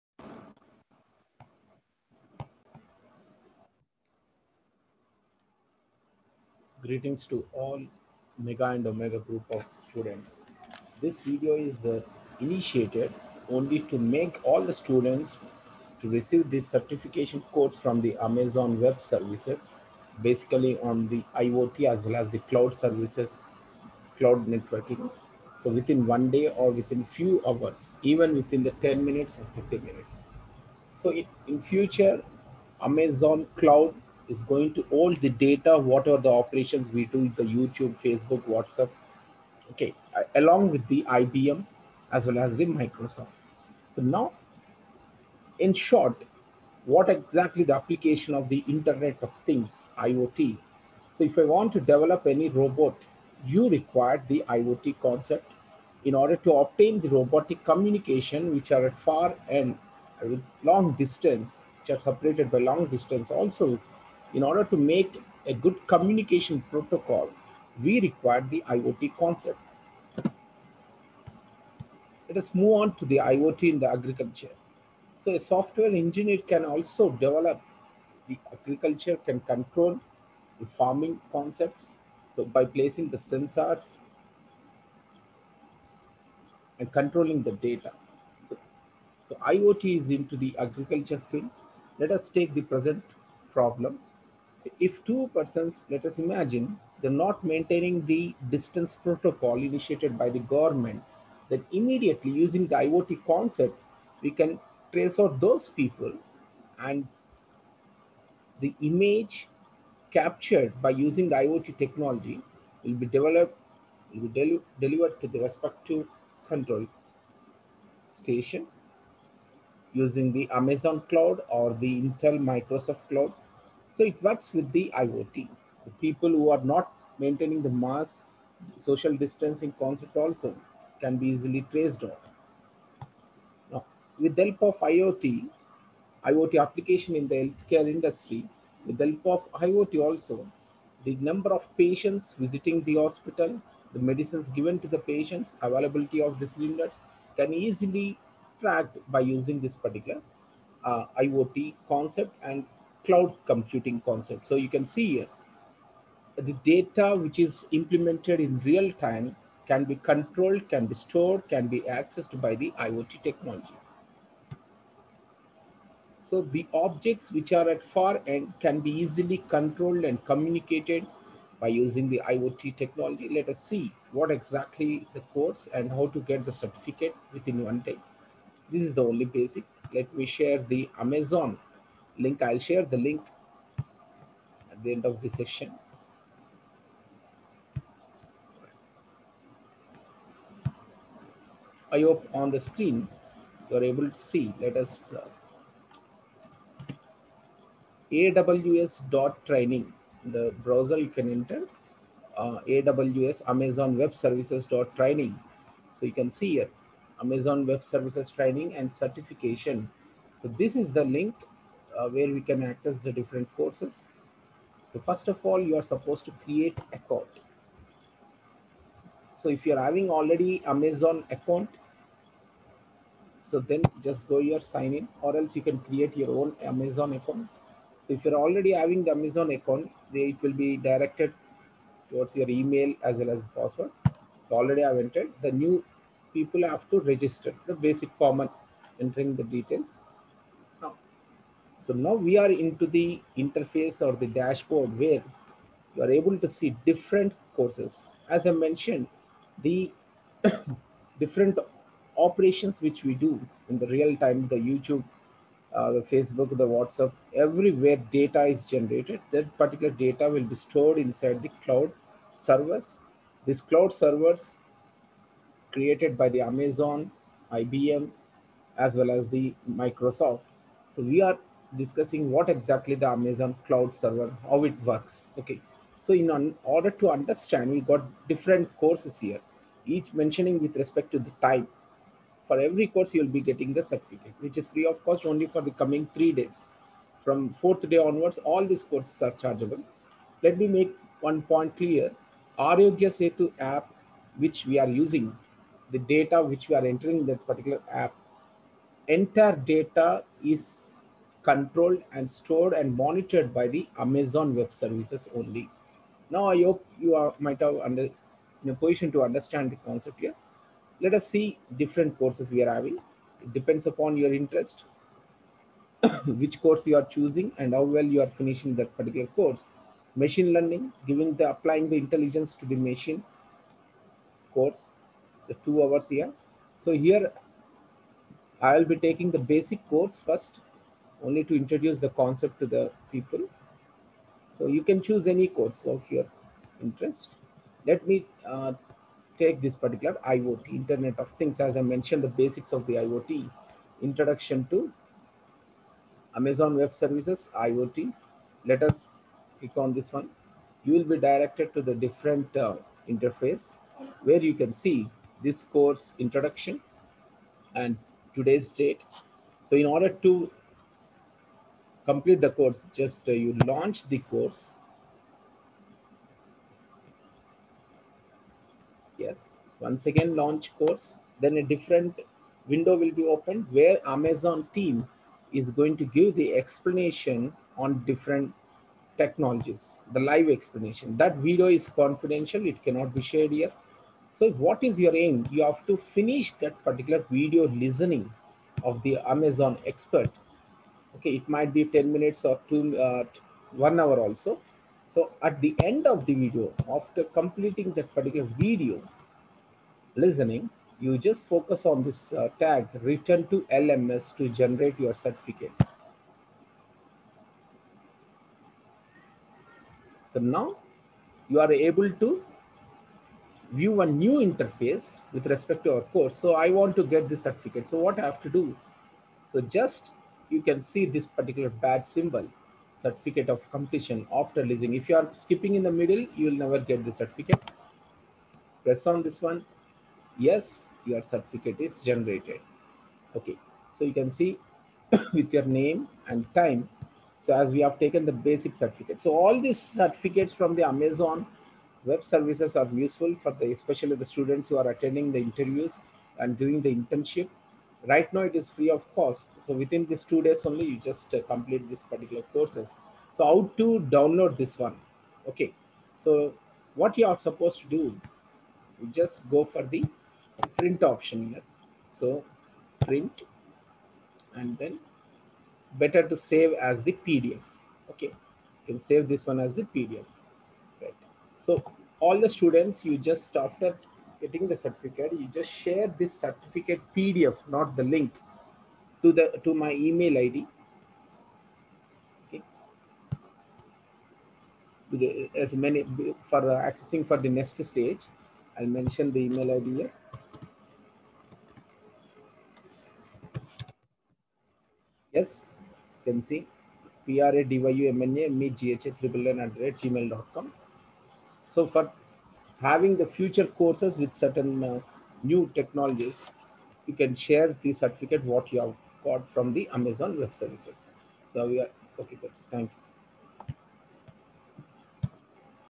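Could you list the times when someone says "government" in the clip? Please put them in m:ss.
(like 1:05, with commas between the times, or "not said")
1:40.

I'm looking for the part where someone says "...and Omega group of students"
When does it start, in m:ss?
0:08.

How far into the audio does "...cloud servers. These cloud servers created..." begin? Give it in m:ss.
4:21.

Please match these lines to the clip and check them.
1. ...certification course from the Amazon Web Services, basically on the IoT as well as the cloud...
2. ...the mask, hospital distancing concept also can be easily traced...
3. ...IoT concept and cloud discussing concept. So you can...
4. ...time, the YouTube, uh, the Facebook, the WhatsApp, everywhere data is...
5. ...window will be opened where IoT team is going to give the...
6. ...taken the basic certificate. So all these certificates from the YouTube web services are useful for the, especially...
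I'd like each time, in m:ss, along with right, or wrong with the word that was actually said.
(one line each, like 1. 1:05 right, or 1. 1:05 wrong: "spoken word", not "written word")
1. 0:16 right
2. 2:07 wrong: "social", not "hospital"
3. 2:31 wrong: "computing", not "discussing"
4. 4:14 right
5. 6:12 wrong: "Amazon", not "IoT"
6. 7:17 wrong: "Amazon", not "YouTube".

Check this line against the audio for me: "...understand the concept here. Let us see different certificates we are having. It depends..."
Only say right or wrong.
wrong.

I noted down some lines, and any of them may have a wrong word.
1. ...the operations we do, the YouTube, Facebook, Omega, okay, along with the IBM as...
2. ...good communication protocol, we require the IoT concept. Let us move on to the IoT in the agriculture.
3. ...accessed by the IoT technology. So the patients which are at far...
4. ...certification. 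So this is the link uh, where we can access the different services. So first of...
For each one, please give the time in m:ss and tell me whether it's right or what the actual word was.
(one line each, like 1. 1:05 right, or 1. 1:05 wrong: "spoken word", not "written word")
1. 0:36 wrong: "WhatsApp", not "Omega"
2. 1:05 right
3. 2:41 wrong: "objects", not "patients"
4. 3:28 wrong: "courses", not "services".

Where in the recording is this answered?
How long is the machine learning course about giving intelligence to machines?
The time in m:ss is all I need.
5:25.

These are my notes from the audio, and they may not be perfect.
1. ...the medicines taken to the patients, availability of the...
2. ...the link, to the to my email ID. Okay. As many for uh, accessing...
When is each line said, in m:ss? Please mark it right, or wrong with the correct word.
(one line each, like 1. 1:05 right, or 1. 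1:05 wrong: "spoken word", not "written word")
1. 2:23 wrong: "given", not "taken"
2. 7:57 right.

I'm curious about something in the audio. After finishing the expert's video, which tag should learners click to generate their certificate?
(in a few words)
Return to LMS.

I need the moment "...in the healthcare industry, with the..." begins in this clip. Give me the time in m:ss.
2:17.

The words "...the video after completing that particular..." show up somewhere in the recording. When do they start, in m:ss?
6:36.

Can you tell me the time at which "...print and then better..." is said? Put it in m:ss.
7:43.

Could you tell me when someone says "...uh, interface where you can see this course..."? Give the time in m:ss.
5:52.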